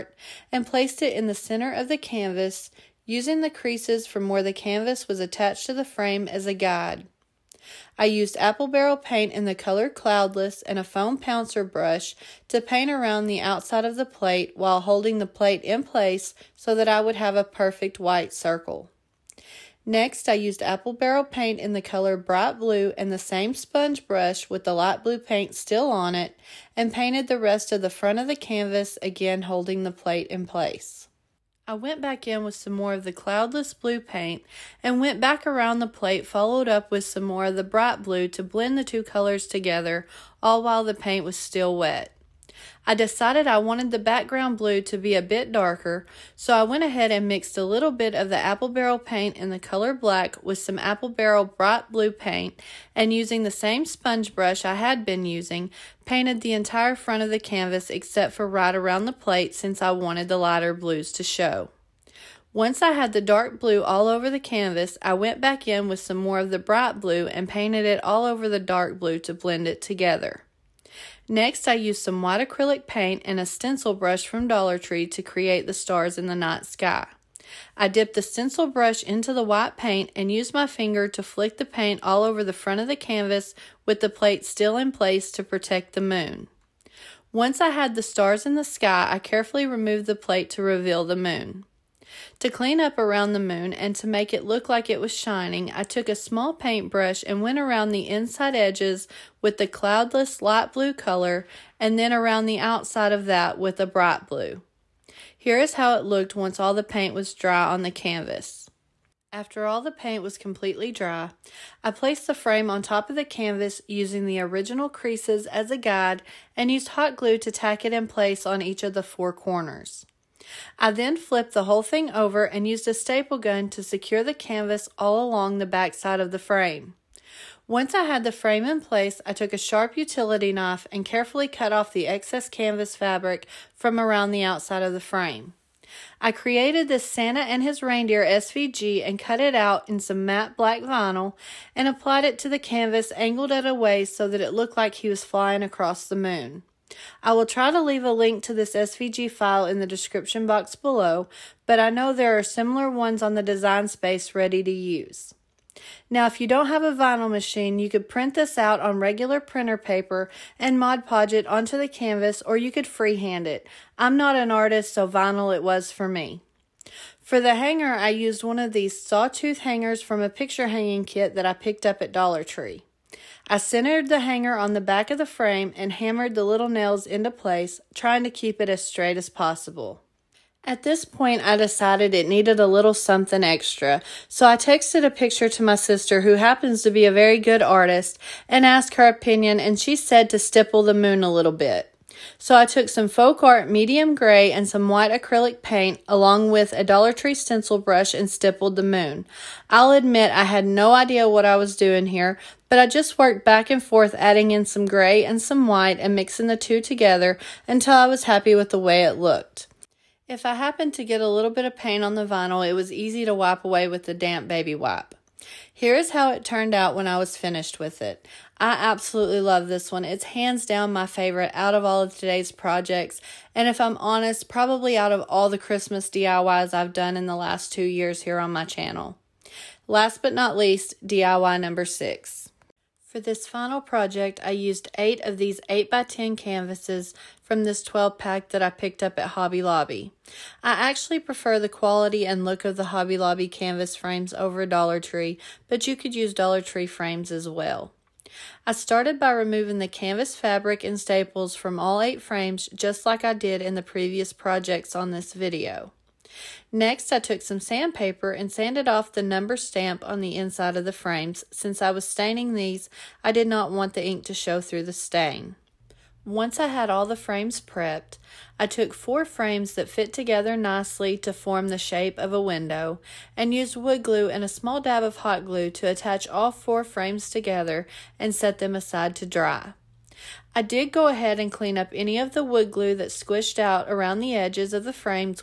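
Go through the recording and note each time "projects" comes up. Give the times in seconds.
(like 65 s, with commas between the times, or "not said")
222 s, 233 s, 254 s.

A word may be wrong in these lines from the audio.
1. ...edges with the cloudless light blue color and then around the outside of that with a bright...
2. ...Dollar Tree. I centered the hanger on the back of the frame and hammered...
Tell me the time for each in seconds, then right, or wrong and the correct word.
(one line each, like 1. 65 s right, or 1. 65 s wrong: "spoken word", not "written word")
1. 98 s right
2. 172 s right.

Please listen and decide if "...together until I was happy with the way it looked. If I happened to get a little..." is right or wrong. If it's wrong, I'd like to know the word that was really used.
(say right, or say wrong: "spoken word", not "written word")
right.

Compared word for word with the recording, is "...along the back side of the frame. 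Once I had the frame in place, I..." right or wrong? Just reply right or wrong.
right.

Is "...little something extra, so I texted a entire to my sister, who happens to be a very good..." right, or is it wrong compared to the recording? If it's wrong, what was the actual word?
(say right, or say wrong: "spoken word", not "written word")
wrong: "picture", not "entire".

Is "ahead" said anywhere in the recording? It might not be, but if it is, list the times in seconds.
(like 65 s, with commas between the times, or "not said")
46 s, 281 s.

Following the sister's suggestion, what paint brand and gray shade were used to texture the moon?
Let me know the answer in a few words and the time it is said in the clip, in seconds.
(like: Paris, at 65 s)
Folk Art medium gray, at 193 s.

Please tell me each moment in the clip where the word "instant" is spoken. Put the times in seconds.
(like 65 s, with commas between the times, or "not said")
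not said.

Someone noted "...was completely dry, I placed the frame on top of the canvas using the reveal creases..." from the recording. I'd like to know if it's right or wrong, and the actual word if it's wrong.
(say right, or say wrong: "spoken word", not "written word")
wrong: "original", not "reveal".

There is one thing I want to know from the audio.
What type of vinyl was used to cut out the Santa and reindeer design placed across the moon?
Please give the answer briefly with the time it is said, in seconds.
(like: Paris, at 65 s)
matte black vinyl, at 140 s.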